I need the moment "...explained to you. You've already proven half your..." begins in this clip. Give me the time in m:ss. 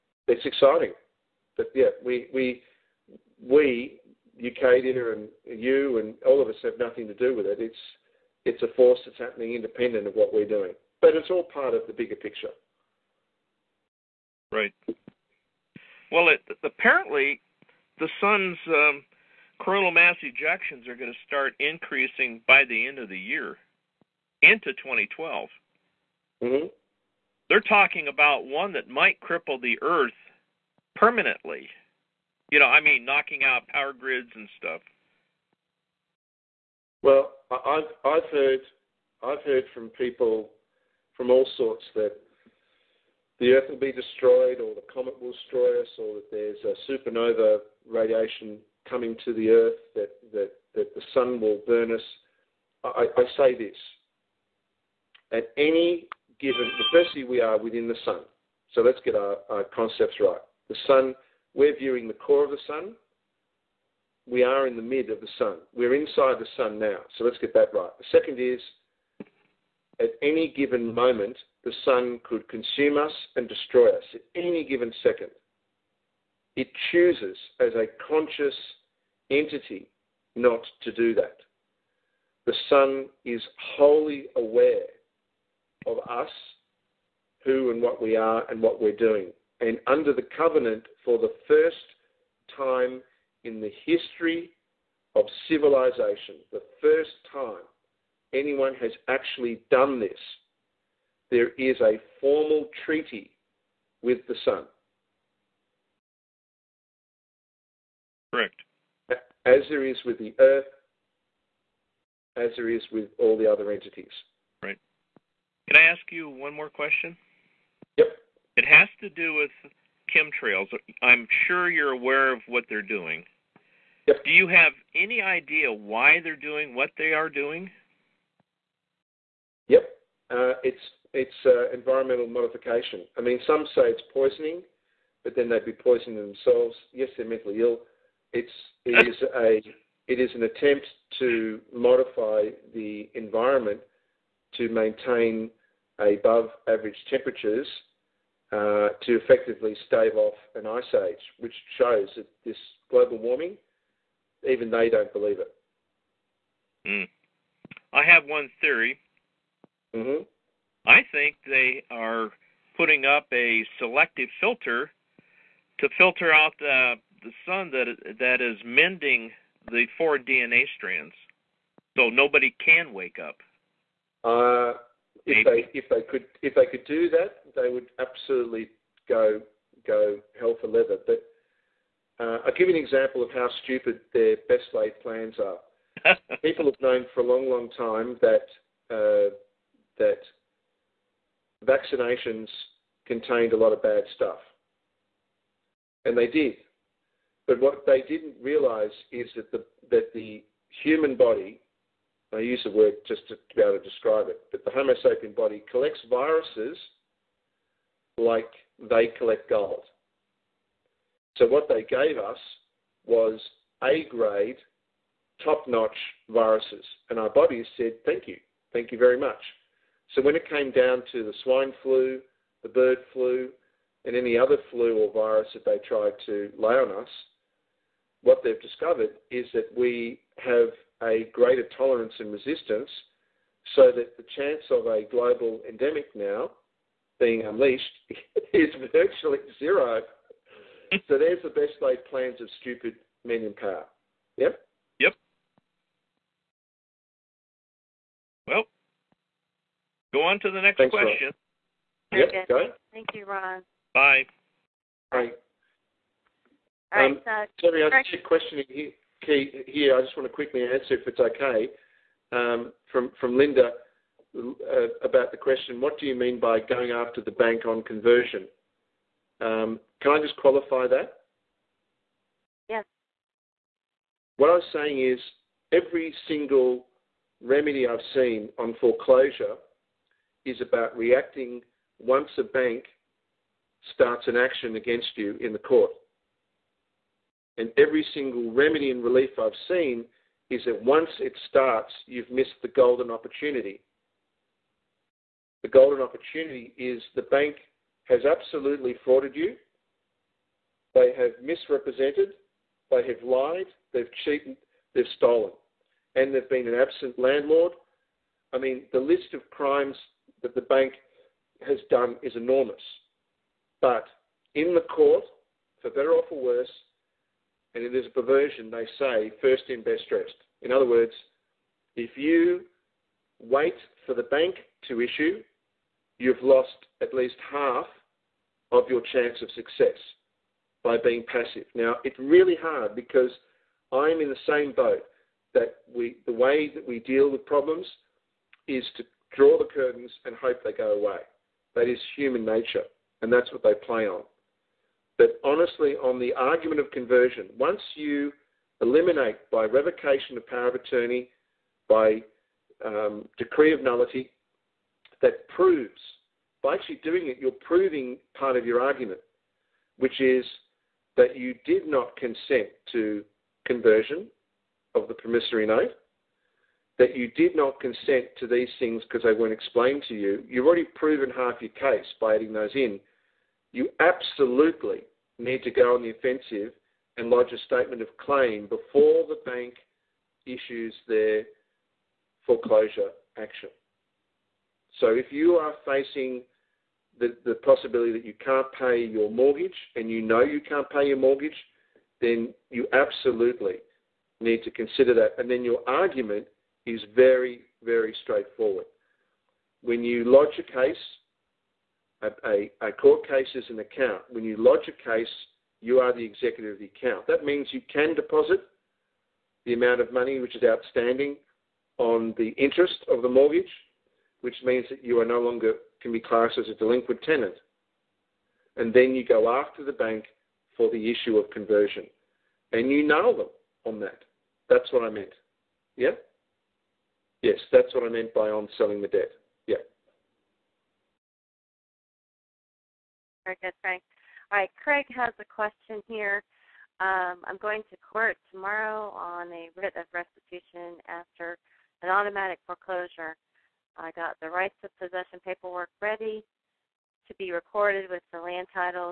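6:09.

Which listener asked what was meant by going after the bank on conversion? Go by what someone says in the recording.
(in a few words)
Linda.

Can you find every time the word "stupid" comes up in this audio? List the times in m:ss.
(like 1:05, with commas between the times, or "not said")
3:03, 4:02.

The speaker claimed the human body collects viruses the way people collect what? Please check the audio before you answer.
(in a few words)
Gold.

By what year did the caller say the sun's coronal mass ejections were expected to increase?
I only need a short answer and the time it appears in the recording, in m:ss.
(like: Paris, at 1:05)
2012, at 0:24.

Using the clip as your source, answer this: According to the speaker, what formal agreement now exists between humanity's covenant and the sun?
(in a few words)
A formal treaty.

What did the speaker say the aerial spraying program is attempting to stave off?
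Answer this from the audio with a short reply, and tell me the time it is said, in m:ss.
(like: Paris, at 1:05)
An ice age, at 2:30.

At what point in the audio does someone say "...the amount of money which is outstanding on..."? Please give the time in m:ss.
6:49.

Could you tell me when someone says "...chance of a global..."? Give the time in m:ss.
3:54.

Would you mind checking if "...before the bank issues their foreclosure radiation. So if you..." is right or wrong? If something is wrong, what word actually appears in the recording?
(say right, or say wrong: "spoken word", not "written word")
wrong: "action", not "radiation".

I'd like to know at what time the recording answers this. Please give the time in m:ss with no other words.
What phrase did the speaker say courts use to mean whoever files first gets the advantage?
5:19.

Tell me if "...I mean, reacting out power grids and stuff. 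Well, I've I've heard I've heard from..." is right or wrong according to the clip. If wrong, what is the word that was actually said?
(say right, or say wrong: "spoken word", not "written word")
wrong: "knocking", not "reacting".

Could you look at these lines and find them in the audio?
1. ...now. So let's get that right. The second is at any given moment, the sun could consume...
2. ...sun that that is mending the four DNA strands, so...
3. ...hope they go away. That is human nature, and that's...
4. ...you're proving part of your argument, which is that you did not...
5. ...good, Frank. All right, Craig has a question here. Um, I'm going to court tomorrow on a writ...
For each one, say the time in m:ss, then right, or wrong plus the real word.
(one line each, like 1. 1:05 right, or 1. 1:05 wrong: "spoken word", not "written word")
1. 1:06 right
2. 2:47 right
3. 5:40 right
4. 5:57 right
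5. 7:13 right.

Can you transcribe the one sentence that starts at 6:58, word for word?
And then you go after the bank for the issue of conversion.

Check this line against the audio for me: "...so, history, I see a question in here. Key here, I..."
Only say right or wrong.
wrong.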